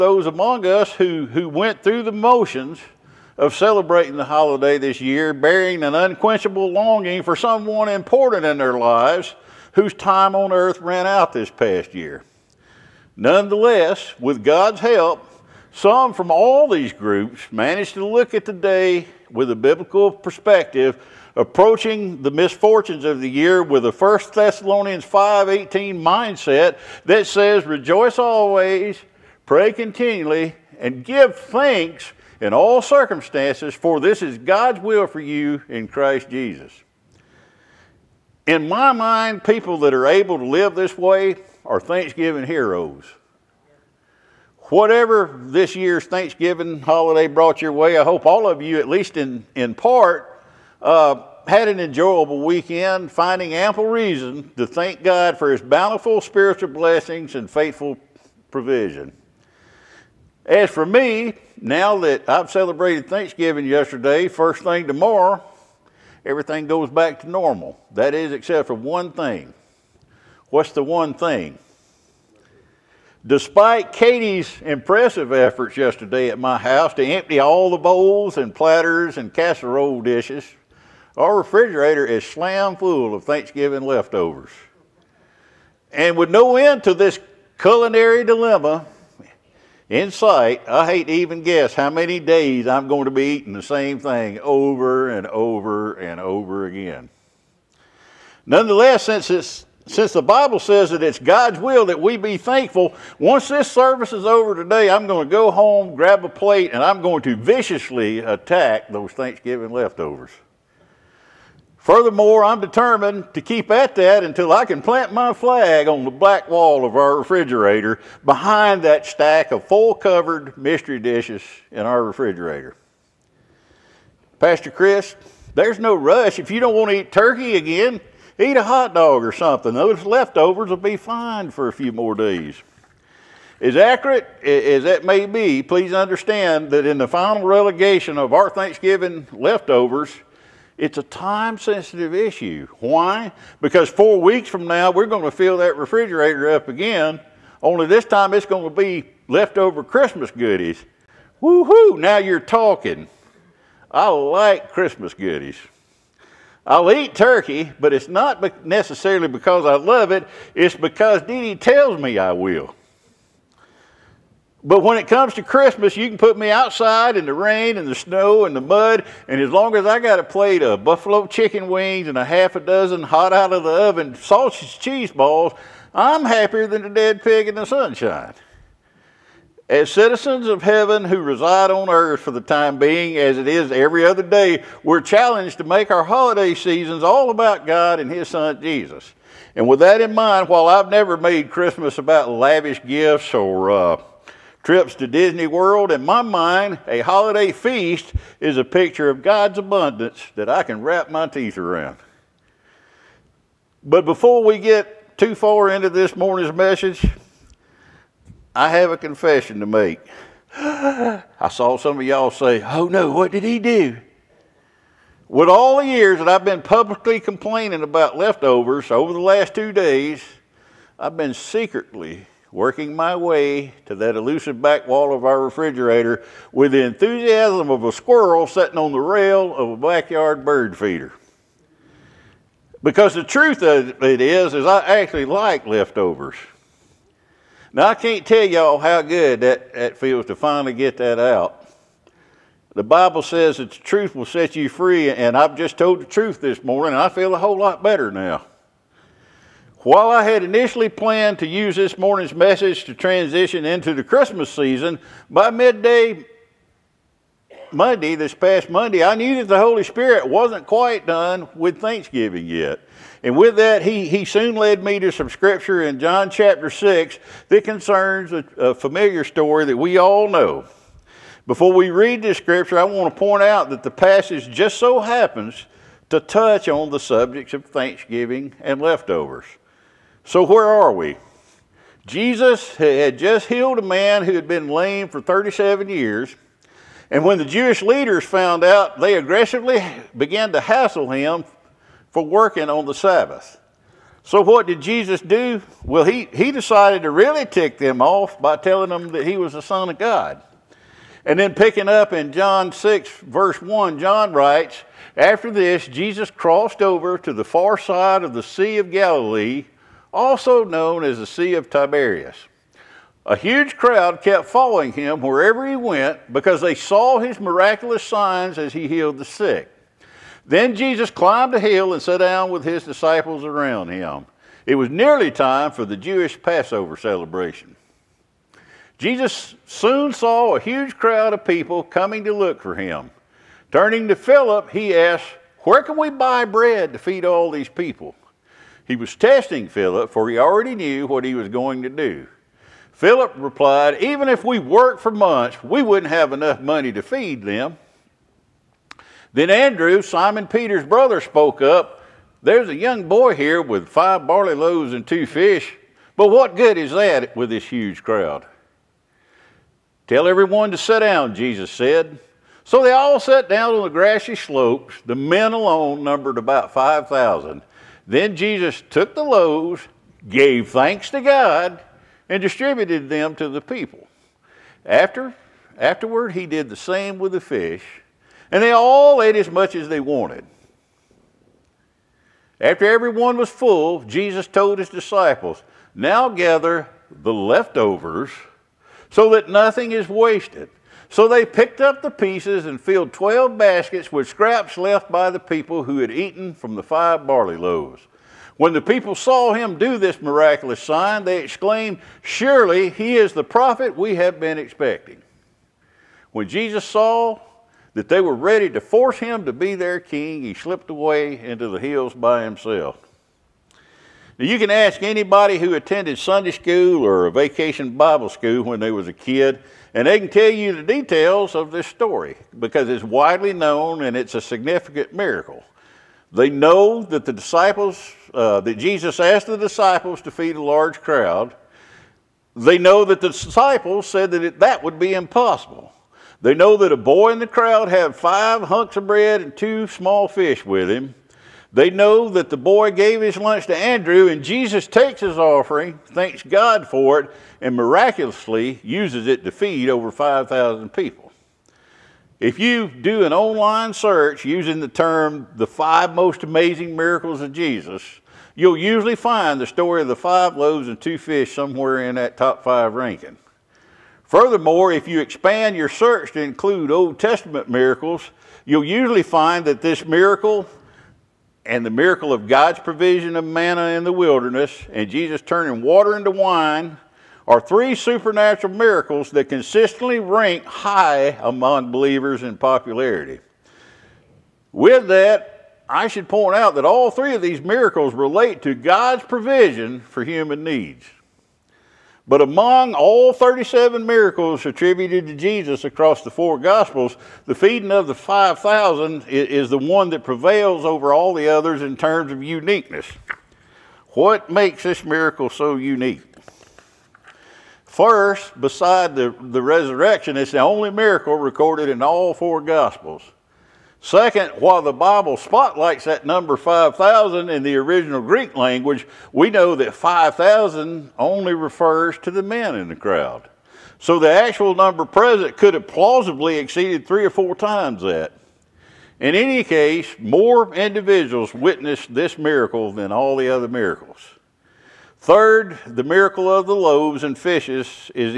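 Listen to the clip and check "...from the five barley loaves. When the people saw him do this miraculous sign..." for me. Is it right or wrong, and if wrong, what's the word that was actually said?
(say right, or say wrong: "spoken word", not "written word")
right.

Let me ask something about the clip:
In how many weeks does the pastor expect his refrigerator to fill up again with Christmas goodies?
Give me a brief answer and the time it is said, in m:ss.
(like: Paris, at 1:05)
4, at 2:23.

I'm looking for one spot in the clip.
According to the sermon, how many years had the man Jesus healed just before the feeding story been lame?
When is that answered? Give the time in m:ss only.
4:45.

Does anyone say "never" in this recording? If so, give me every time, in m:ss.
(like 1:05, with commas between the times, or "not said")
3:10.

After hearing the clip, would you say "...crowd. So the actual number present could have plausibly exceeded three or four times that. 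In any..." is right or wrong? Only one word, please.
right.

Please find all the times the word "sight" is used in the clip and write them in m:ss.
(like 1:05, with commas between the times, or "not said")
1:30.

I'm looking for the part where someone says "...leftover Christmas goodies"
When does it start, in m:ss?
2:29.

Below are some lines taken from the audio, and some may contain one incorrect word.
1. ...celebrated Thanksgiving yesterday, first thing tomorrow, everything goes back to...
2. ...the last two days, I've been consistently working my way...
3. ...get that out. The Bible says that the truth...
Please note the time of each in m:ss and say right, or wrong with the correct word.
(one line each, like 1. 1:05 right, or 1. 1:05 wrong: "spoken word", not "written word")
1. 1:02 right
2. 3:39 wrong: "secretly", not "consistently"
3. 4:00 right.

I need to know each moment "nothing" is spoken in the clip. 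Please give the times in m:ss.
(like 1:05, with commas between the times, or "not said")
6:29.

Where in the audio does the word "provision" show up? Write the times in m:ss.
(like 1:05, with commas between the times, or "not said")
0:58, 7:52, 8:09.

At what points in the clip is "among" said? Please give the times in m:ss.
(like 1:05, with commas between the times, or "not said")
0:00, 8:01, 8:12.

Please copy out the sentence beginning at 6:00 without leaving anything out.
Tell everyone to sit down, Jesus said.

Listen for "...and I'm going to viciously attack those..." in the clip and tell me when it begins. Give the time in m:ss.
1:46.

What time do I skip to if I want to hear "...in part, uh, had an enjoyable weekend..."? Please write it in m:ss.
0:49.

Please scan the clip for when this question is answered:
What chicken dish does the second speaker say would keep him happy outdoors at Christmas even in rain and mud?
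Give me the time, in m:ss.
2:50.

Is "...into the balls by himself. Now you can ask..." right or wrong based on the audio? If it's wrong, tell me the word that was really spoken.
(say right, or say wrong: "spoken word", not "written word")
wrong: "hills", not "balls".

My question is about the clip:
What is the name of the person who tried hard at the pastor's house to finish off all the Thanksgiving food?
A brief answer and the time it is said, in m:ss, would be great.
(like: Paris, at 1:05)
Katie, at 1:13.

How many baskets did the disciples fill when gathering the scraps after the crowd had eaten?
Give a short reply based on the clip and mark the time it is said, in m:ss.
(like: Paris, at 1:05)
12, at 6:33.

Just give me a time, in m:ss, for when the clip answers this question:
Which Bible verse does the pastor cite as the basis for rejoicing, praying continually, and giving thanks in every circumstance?
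0:23.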